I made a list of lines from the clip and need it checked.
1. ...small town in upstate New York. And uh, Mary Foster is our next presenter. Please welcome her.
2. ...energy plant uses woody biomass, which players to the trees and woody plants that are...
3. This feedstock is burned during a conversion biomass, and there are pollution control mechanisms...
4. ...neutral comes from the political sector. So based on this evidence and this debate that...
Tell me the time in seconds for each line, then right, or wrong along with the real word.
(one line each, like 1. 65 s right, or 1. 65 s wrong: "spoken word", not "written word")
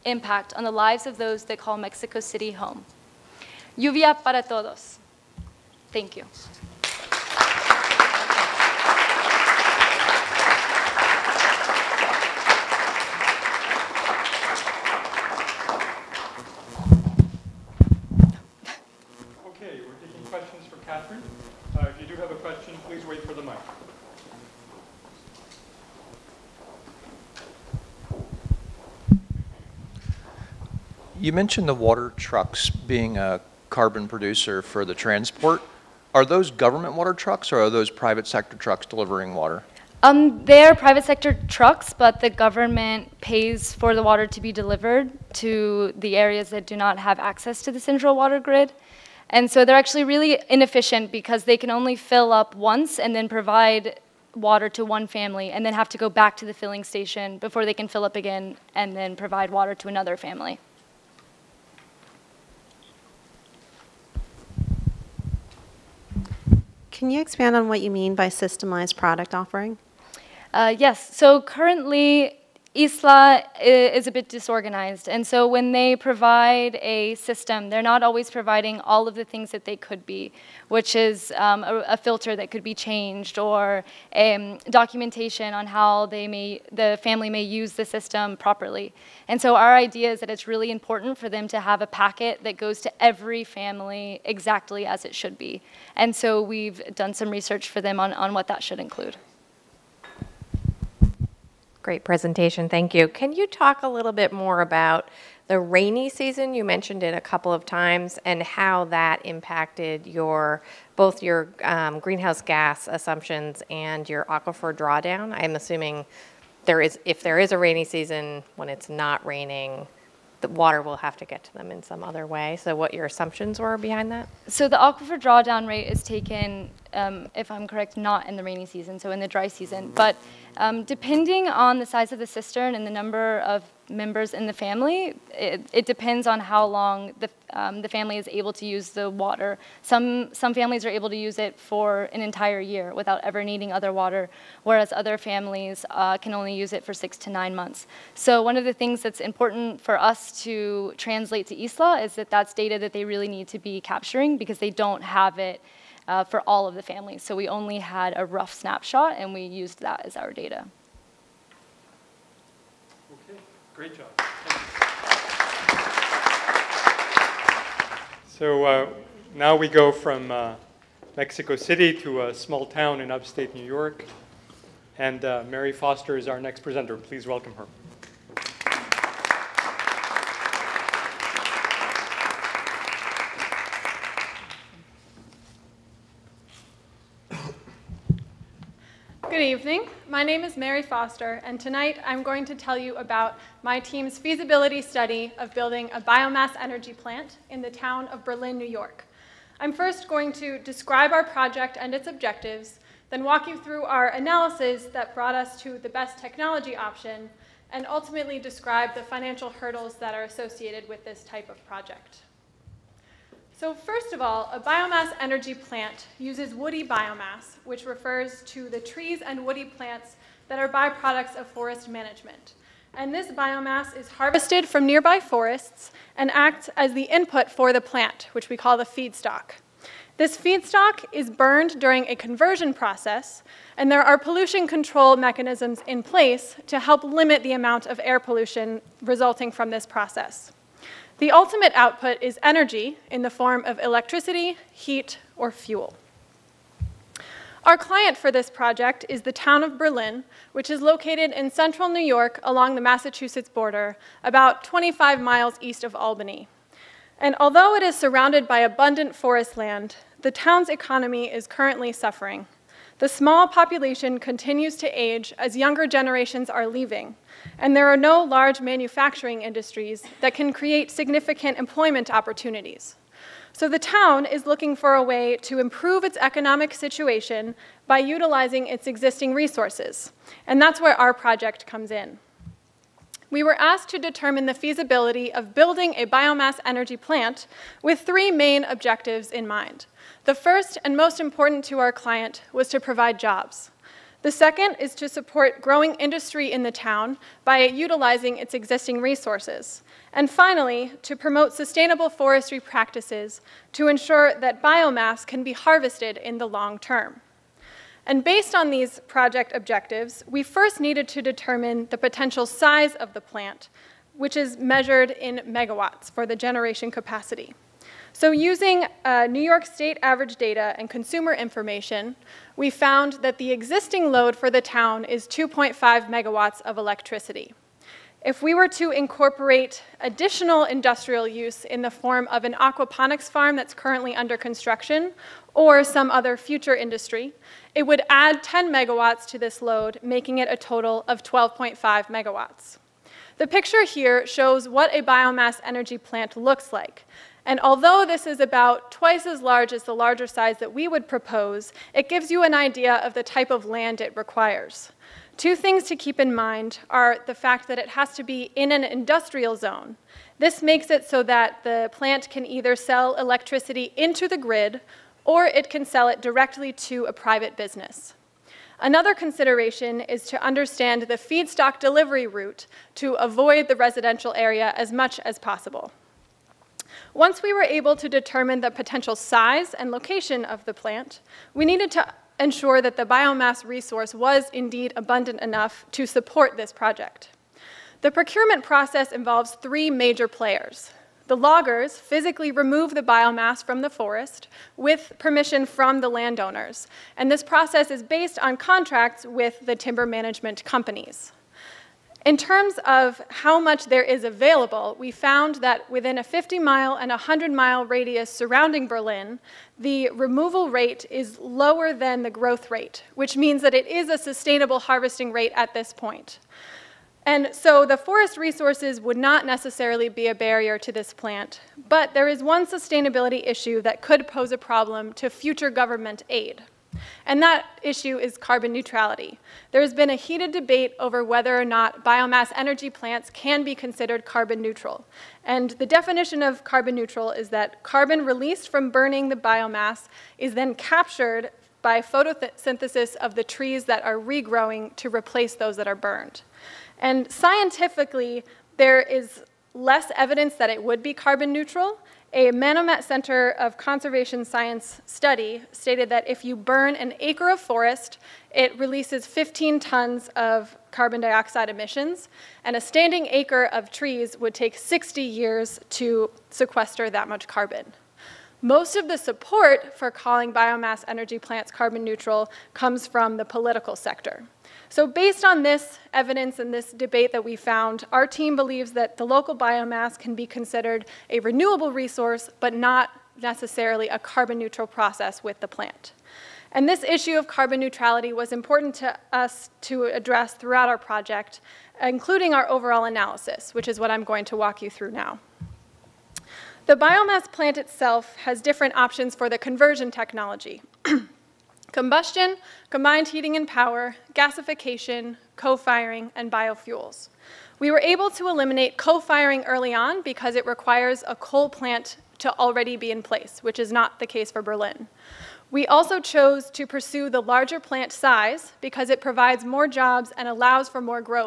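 1. 172 s right
2. 215 s wrong: "refers", not "players"
3. 230 s wrong: "process", not "biomass"
4. 472 s right.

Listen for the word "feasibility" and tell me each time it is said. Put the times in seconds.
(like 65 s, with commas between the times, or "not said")
194 s, 284 s.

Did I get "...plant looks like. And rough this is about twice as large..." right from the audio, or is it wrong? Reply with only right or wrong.
wrong.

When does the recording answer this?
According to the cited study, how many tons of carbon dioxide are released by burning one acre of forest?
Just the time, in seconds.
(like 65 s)
459 s.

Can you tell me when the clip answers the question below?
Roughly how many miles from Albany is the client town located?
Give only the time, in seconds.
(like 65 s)
254 s.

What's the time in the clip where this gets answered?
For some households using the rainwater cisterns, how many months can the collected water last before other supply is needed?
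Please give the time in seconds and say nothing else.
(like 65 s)
146 s.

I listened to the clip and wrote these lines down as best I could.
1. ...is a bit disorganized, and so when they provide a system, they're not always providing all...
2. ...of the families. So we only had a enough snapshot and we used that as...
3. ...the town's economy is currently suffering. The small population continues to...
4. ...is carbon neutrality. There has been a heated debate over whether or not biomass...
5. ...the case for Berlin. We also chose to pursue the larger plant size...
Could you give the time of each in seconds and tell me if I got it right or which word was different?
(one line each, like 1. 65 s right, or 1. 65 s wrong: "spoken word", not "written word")
1. 73 s right
2. 156 s wrong: "rough", not "enough"
3. 260 s right
4. 428 s right
5. 514 s right.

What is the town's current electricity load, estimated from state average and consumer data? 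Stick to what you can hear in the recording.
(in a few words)
2.5 megawatts.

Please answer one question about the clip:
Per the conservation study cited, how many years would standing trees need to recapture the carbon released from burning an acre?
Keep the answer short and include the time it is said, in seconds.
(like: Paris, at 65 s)
60 years, at 464 s.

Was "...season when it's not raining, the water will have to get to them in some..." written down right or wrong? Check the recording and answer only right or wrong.
right.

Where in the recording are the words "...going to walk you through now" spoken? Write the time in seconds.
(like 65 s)
494 s.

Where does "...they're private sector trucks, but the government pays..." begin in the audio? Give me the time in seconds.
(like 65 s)
40 s.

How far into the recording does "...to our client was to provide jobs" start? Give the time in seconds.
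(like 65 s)
291 s.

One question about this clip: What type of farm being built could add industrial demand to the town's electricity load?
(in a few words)
Aquaponics farm.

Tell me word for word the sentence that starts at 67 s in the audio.
Can you expand on what you mean by systemized product offering?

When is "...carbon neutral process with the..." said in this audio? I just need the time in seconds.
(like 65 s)
484 s.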